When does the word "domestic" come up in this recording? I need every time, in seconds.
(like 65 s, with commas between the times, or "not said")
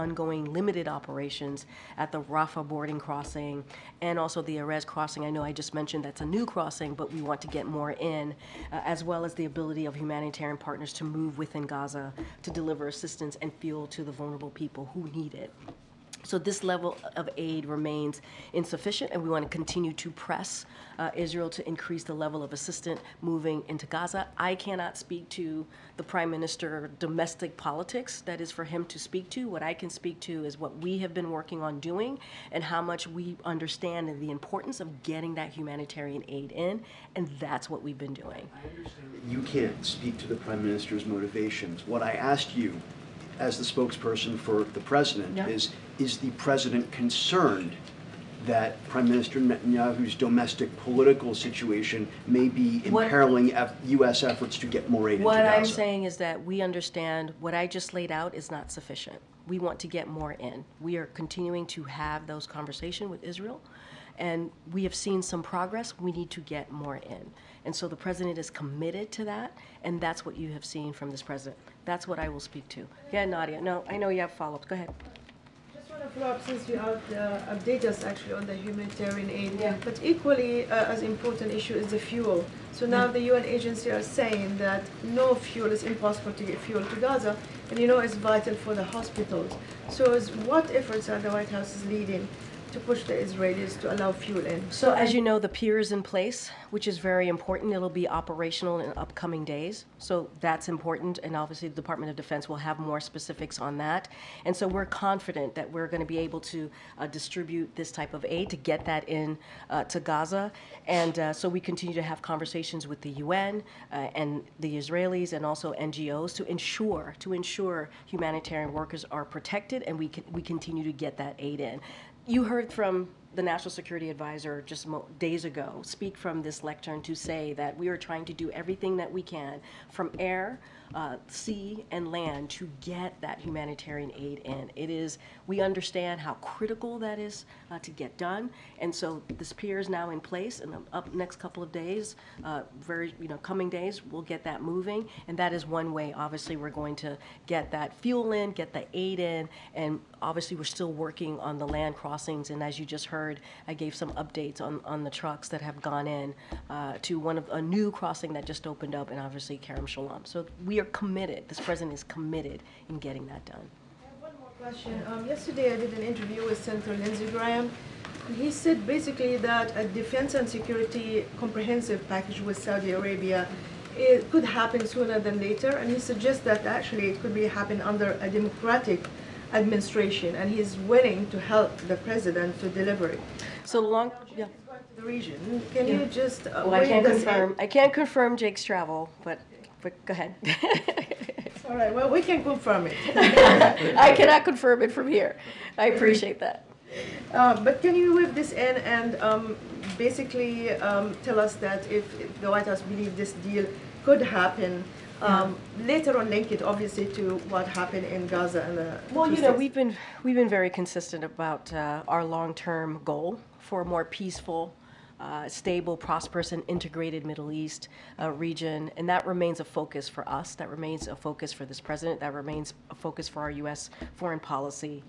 26 s, 50 s.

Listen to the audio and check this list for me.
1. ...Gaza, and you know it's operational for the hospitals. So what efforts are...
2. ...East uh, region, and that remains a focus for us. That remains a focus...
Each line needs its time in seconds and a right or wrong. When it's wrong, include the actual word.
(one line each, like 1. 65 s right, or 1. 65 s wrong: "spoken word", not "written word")
1. 86 s wrong: "vital", not "operational"
2. 217 s right.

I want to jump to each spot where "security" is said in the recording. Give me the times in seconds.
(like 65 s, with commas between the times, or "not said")
123 s, 170 s.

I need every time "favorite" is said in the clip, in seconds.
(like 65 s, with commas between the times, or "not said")
not said.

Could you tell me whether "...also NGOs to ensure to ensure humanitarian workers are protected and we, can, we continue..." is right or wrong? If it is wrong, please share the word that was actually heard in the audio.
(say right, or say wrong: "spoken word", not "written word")
right.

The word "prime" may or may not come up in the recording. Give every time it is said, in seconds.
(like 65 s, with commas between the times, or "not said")
26 s, 40 s, 48 s.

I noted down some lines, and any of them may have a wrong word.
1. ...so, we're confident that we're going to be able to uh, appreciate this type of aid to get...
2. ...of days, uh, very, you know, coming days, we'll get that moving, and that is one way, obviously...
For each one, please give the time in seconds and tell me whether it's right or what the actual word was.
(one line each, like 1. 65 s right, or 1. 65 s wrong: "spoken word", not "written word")
1. 104 s wrong: "distribute", not "appreciate"
2. 141 s right.